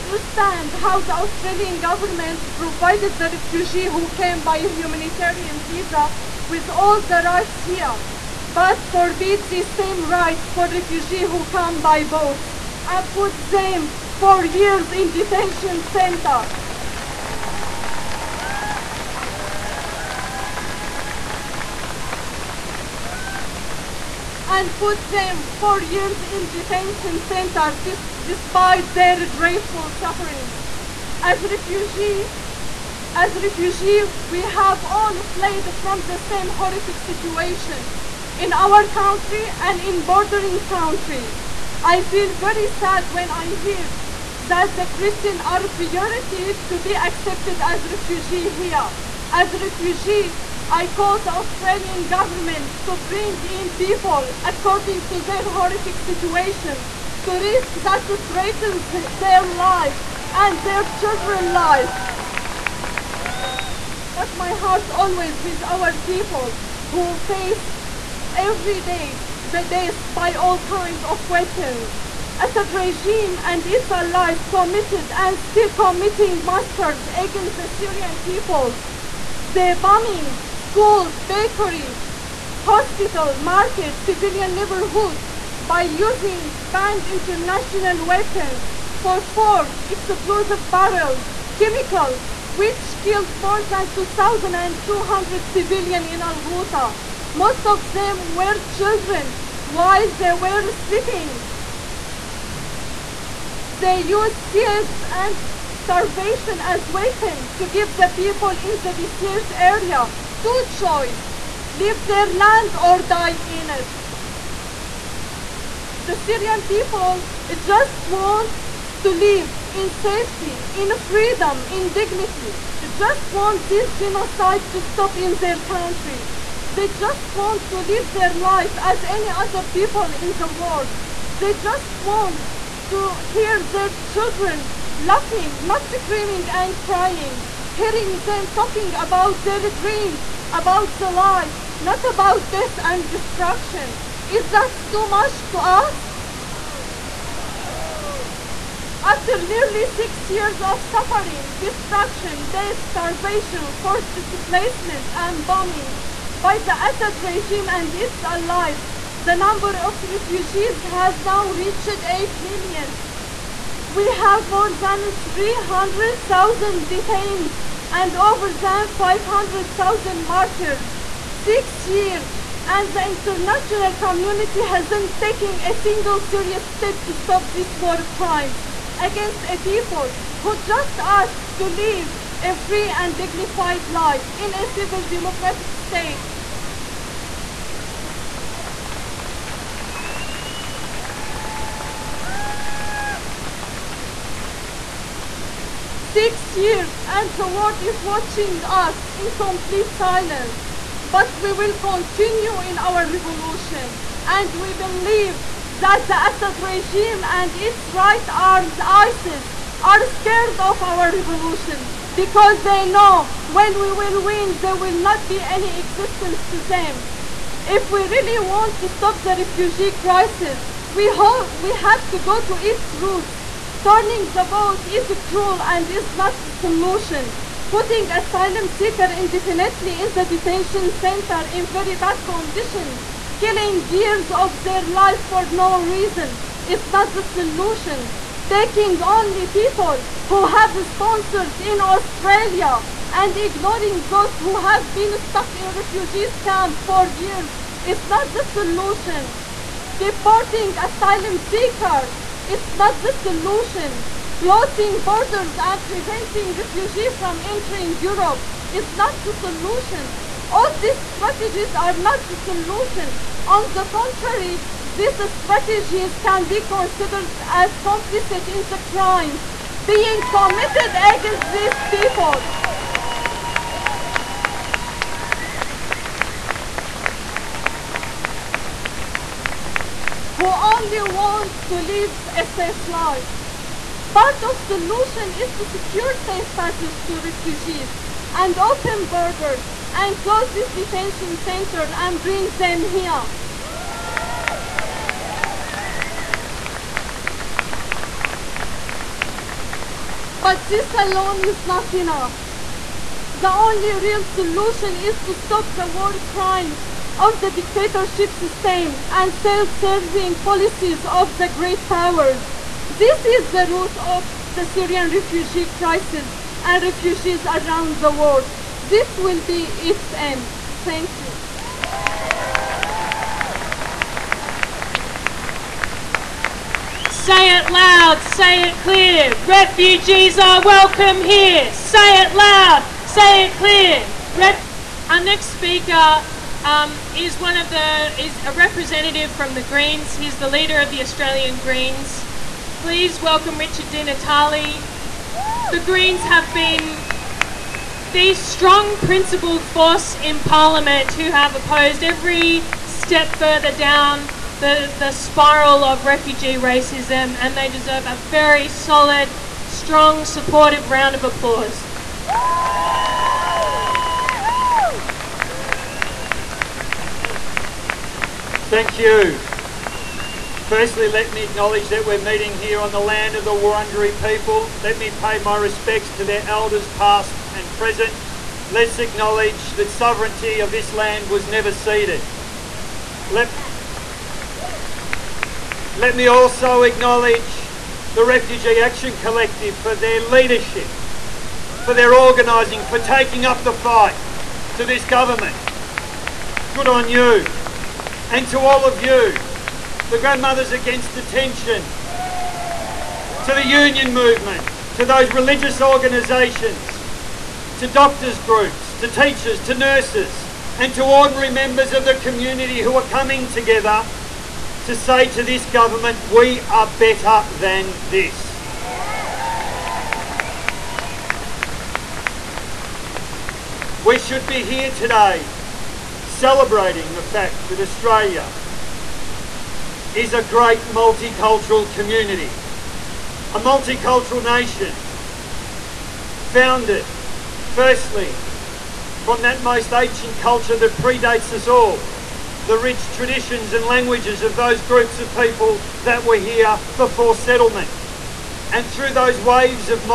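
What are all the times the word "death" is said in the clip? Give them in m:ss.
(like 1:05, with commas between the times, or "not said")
1:09, 2:22, 2:32.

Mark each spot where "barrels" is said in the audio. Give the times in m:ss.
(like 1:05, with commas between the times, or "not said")
1:30.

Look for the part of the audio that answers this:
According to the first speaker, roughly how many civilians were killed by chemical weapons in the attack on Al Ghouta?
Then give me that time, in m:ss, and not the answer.
1:33.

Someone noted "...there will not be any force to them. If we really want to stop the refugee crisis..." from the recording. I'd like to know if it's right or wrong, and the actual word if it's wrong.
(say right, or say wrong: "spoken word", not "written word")
wrong: "existence", not "force".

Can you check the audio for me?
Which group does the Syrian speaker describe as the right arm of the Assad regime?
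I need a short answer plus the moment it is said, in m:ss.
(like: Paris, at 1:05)
ISIS, at 3:28.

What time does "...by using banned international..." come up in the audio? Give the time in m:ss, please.
1:25.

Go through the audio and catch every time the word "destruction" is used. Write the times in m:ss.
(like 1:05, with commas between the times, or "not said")
2:23, 2:31.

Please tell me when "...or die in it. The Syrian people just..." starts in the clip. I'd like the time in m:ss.
1:52.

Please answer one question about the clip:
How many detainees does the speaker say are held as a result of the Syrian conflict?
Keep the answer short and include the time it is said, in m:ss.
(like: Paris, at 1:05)
300,000, at 2:45.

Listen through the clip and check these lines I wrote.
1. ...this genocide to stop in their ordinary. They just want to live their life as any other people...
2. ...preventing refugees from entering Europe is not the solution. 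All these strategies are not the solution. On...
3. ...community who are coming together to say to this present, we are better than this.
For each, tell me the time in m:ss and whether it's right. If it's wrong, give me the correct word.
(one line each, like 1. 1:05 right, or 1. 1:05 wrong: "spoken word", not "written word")
1. 2:03 wrong: "country", not "ordinary"
2. 4:15 right
3. 6:52 wrong: "government", not "present".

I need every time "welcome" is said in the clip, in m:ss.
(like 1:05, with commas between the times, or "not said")
5:30, 5:43.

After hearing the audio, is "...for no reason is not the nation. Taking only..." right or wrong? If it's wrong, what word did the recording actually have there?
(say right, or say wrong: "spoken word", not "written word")
wrong: "solution", not "nation".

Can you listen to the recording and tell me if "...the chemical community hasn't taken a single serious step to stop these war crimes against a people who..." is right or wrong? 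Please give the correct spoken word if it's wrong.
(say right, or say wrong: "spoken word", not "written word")
wrong: "international", not "chemical".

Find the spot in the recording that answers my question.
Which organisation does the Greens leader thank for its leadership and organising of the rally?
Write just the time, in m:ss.
6:28.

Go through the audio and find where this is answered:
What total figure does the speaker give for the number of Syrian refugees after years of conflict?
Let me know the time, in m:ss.
2:42.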